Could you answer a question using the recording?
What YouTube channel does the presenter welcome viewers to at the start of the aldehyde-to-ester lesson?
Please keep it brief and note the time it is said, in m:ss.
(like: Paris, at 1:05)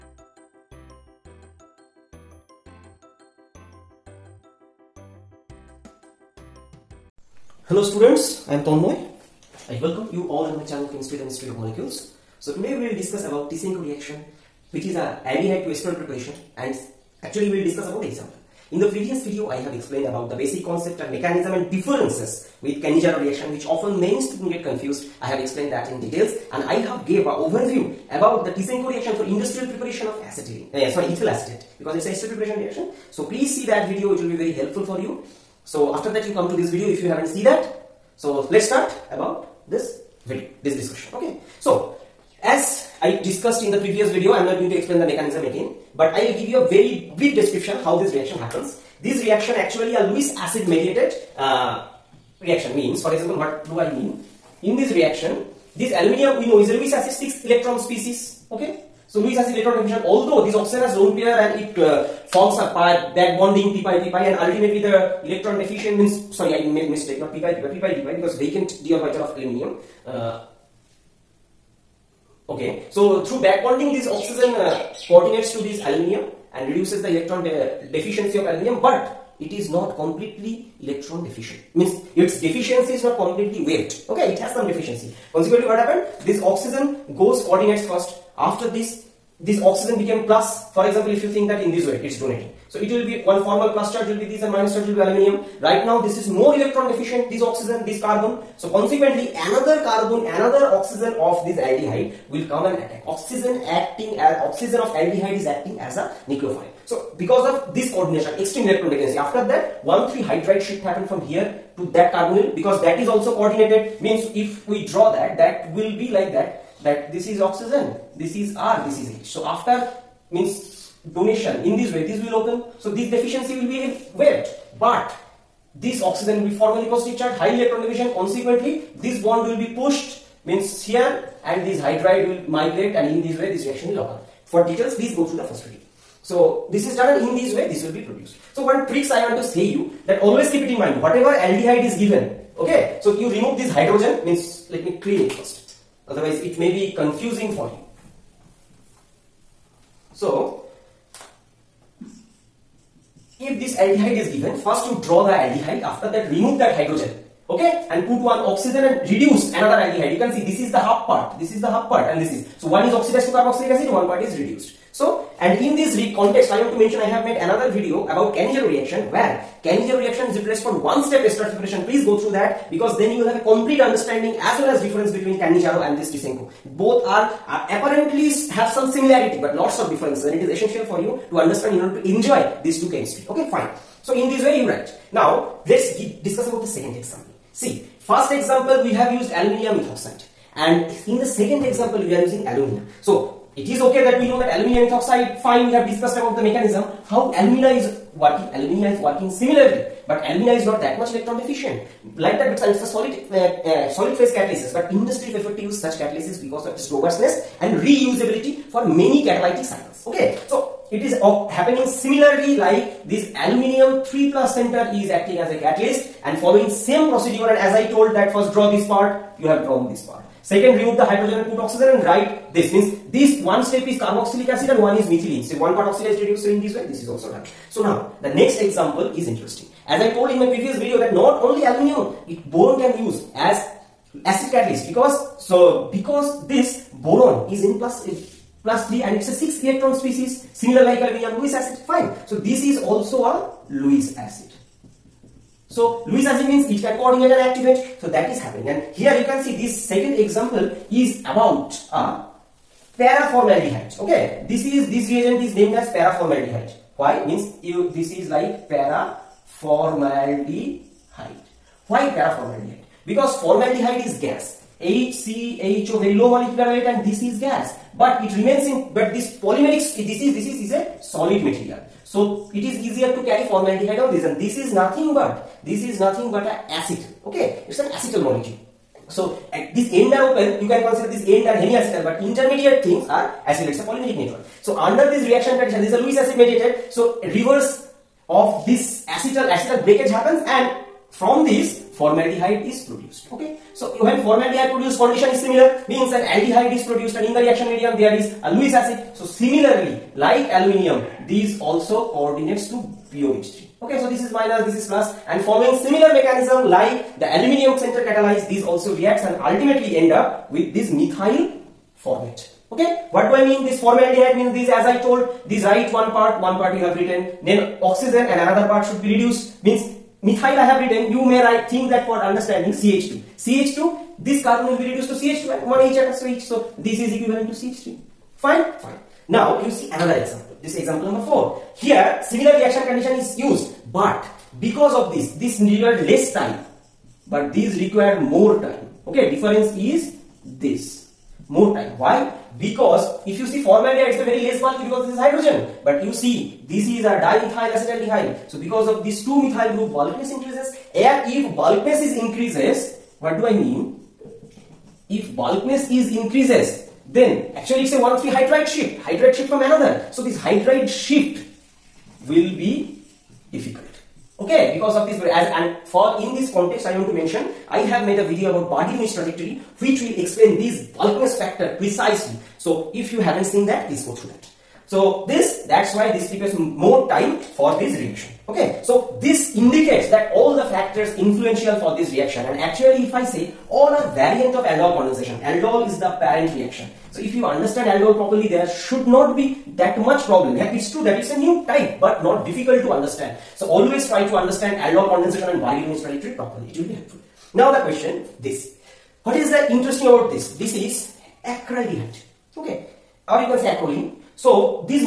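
Chemistry The Mystery of Molecules, at 0:10.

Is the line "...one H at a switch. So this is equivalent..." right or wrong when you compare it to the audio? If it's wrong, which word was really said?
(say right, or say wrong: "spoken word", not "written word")
right.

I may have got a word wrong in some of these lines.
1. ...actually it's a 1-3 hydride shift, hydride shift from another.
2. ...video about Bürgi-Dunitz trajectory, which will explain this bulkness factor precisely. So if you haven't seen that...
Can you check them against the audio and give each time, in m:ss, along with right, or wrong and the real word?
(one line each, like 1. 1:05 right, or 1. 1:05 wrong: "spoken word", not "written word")
1. 5:57 right
2. 6:08 right.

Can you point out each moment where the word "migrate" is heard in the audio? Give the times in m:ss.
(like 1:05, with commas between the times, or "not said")
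2:12.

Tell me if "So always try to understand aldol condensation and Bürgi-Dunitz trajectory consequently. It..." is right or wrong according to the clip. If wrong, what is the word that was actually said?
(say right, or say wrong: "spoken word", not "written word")
wrong: "properly", not "consequently".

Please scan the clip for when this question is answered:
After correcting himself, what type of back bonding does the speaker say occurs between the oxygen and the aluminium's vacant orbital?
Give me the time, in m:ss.
1:07.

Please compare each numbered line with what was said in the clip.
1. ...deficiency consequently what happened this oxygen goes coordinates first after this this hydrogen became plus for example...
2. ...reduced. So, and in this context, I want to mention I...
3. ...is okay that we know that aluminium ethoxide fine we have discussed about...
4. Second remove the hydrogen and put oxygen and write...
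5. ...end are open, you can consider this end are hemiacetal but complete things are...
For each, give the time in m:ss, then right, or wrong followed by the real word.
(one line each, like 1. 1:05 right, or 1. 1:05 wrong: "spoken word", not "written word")
1. 1:24 wrong: "oxygen", not "hydrogen"
2. 2:44 right
3. 3:13 right
4. 3:40 right
5. 4:39 wrong: "intermediate", not "complete".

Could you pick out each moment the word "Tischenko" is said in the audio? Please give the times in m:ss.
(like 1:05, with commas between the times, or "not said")
0:13, 0:28, 2:56.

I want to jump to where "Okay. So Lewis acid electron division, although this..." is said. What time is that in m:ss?
0:58.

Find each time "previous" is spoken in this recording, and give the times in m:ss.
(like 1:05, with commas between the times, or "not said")
0:18, 0:43, 3:50.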